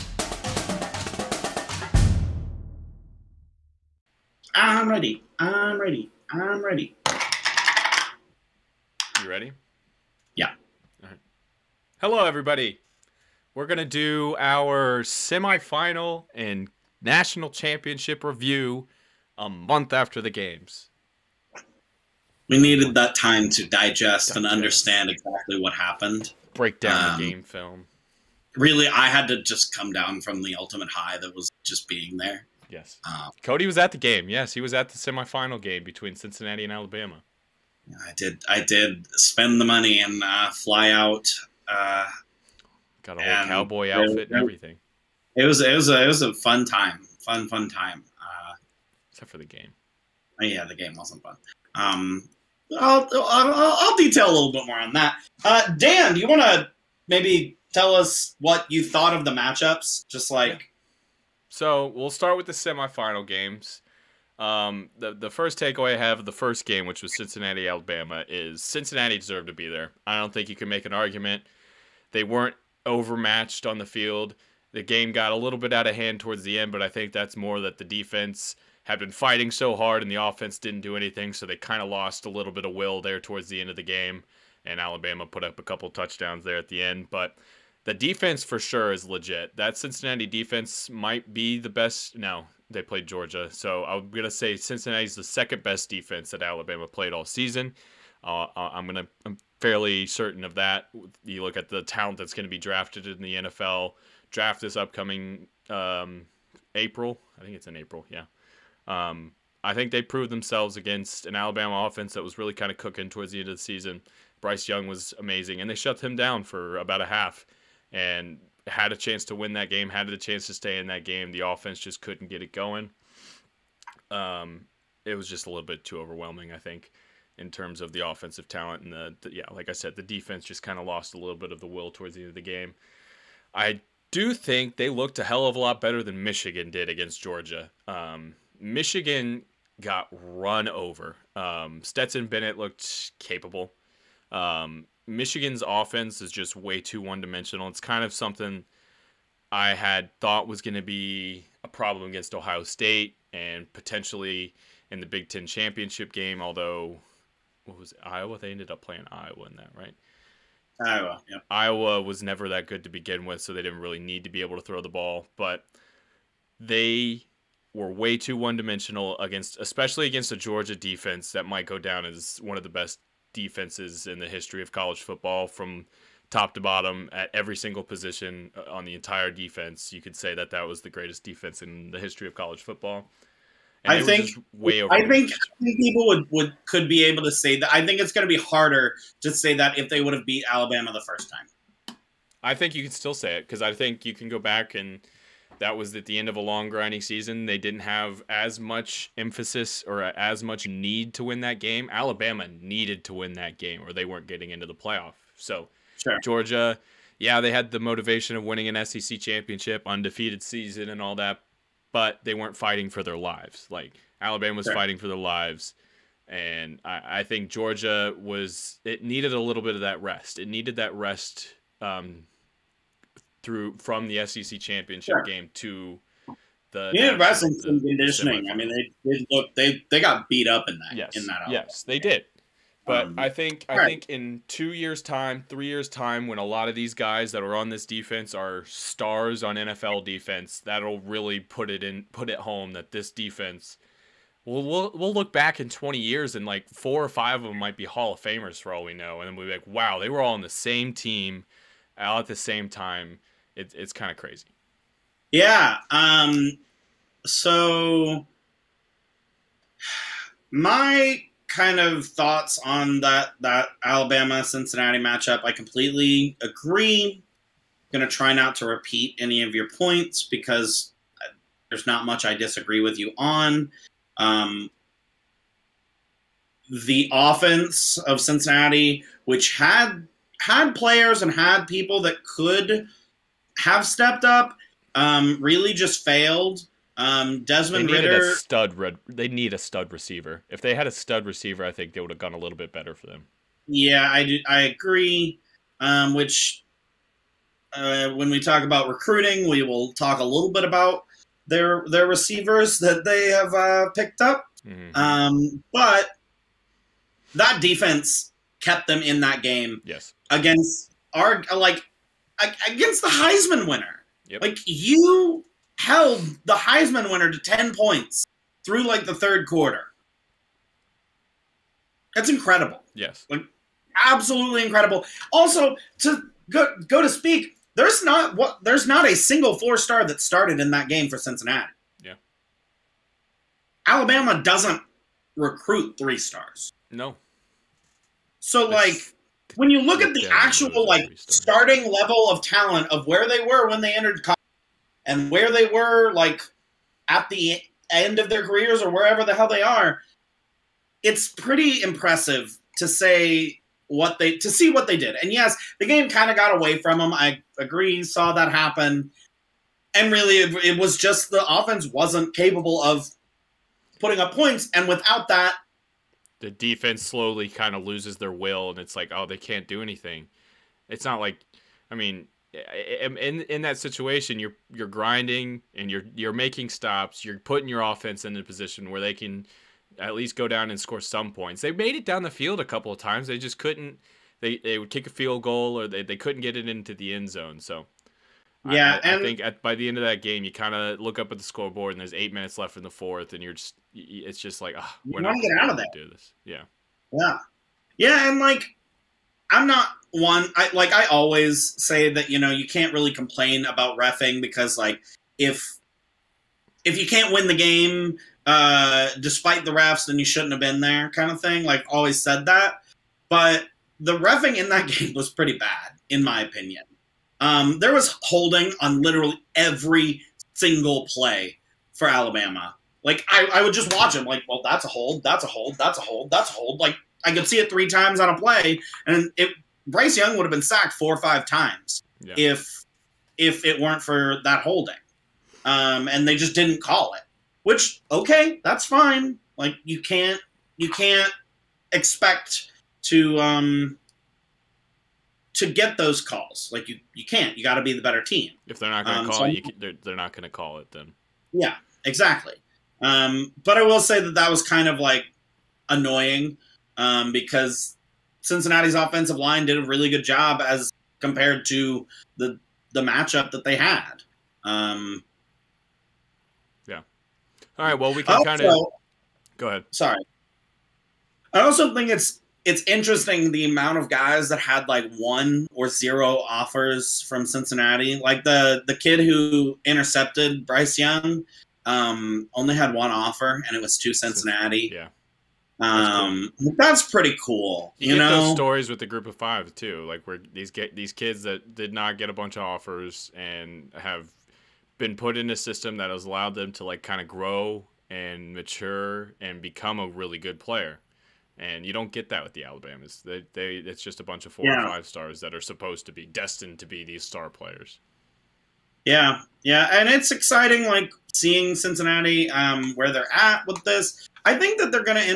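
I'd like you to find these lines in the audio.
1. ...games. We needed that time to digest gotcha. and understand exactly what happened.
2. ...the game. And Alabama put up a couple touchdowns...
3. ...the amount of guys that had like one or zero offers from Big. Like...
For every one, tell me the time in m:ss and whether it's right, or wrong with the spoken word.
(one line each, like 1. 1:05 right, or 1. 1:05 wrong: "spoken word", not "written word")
1. 0:20 right
2. 1:23 right
3. 7:53 wrong: "Cincinnati", not "Big".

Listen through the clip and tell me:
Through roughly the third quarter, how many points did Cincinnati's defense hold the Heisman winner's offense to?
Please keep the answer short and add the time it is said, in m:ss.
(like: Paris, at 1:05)
10, at 5:17.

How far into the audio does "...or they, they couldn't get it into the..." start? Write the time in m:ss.
6:25.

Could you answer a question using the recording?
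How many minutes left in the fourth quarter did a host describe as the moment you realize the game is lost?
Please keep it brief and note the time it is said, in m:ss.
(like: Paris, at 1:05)
8, at 6:32.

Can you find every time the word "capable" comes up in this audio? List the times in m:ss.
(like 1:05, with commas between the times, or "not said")
2:23, 6:02.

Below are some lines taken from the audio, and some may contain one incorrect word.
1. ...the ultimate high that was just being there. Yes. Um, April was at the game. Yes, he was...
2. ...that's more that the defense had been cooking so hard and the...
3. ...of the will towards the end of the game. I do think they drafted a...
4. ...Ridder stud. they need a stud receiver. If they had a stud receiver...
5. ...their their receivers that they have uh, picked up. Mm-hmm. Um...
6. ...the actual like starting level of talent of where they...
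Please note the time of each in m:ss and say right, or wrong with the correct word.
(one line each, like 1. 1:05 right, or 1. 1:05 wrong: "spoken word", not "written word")
1. 0:30 wrong: "Cody", not "April"
2. 1:17 wrong: "fighting", not "cooking"
3. 2:11 wrong: "looked", not "drafted"
4. 4:47 right
5. 5:01 right
6. 5:40 right.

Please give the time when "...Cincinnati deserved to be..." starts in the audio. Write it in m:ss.
1:08.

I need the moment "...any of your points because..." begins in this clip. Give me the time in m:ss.
4:29.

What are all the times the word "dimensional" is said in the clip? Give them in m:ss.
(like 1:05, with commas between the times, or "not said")
2:27, 2:48.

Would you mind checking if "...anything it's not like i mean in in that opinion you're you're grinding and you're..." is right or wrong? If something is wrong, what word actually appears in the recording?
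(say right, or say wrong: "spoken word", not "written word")
wrong: "situation", not "opinion".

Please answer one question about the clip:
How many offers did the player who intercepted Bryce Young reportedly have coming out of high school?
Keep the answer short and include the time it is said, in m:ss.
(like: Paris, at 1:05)
1, at 8:02.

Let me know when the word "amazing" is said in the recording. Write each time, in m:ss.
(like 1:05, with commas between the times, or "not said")
1:55.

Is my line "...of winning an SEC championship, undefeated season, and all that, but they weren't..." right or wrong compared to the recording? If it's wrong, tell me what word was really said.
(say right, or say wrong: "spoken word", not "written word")
right.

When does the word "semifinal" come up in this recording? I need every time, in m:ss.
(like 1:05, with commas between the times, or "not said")
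0:15, 0:34, 1:02.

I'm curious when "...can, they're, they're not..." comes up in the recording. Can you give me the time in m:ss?
7:29.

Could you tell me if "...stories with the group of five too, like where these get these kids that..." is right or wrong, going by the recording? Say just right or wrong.
right.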